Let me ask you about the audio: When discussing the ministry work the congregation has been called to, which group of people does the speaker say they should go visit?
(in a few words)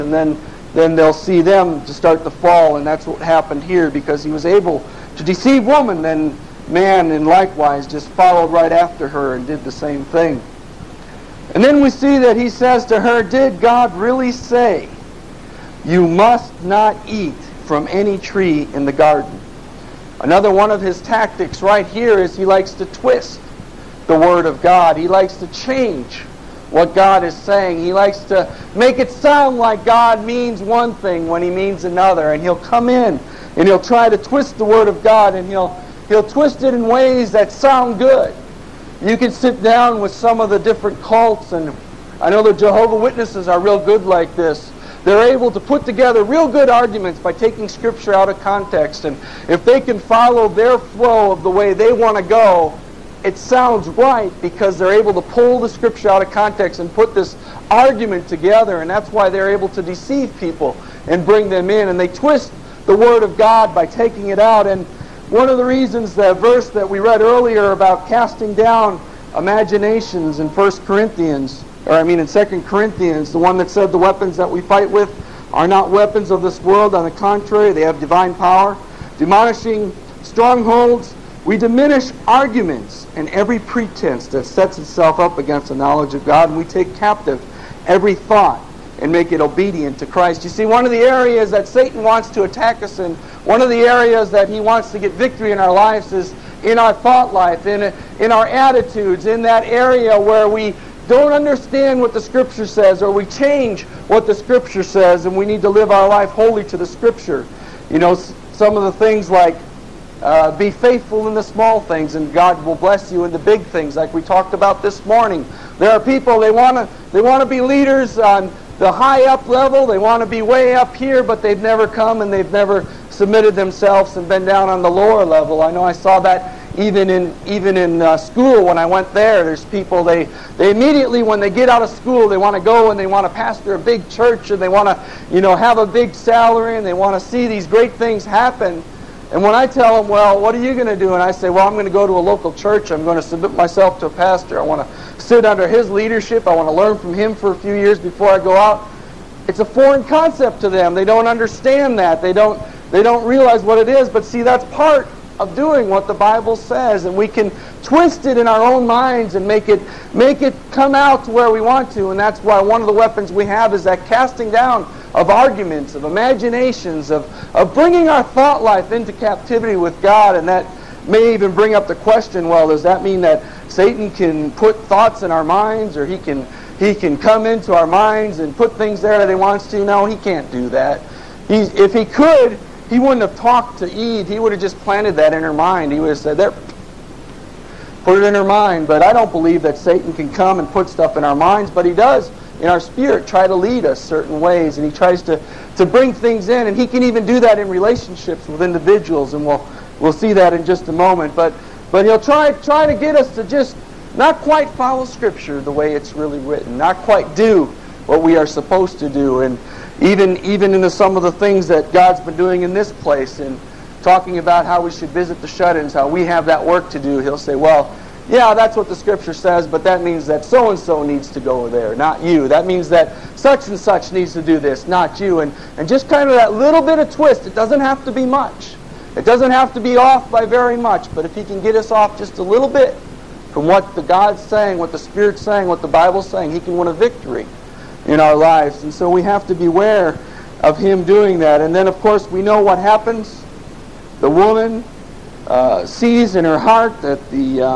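the shut-ins.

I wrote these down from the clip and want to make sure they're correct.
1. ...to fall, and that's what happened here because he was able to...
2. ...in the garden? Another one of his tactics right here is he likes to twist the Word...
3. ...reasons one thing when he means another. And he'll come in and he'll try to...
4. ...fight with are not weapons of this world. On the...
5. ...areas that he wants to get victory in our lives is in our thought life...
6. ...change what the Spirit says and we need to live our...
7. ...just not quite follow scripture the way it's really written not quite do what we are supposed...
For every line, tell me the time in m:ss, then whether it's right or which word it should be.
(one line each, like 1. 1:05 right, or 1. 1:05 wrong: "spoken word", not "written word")
1. 0:02 right
2. 0:18 right
3. 0:30 wrong: "means", not "reasons"
4. 1:14 right
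5. 1:33 right
6. 1:43 wrong: "Scripture", not "Spirit"
7. 3:23 right.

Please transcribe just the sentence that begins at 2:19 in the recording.
And when I tell them, well, what are you going to do?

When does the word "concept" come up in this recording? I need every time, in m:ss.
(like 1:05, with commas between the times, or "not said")
2:30.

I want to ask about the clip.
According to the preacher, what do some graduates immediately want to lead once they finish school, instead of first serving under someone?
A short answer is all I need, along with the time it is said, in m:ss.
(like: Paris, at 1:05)
a big church, at 2:13.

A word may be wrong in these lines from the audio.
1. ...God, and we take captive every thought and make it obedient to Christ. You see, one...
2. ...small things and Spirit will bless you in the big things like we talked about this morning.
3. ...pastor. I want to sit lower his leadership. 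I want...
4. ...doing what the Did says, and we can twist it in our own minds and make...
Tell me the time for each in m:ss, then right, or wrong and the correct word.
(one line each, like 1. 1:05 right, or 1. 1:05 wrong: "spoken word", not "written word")
1. 1:26 right
2. 1:51 wrong: "God", not "Spirit"
3. 2:24 wrong: "under", not "lower"
4. 2:35 wrong: "Bible", not "Did".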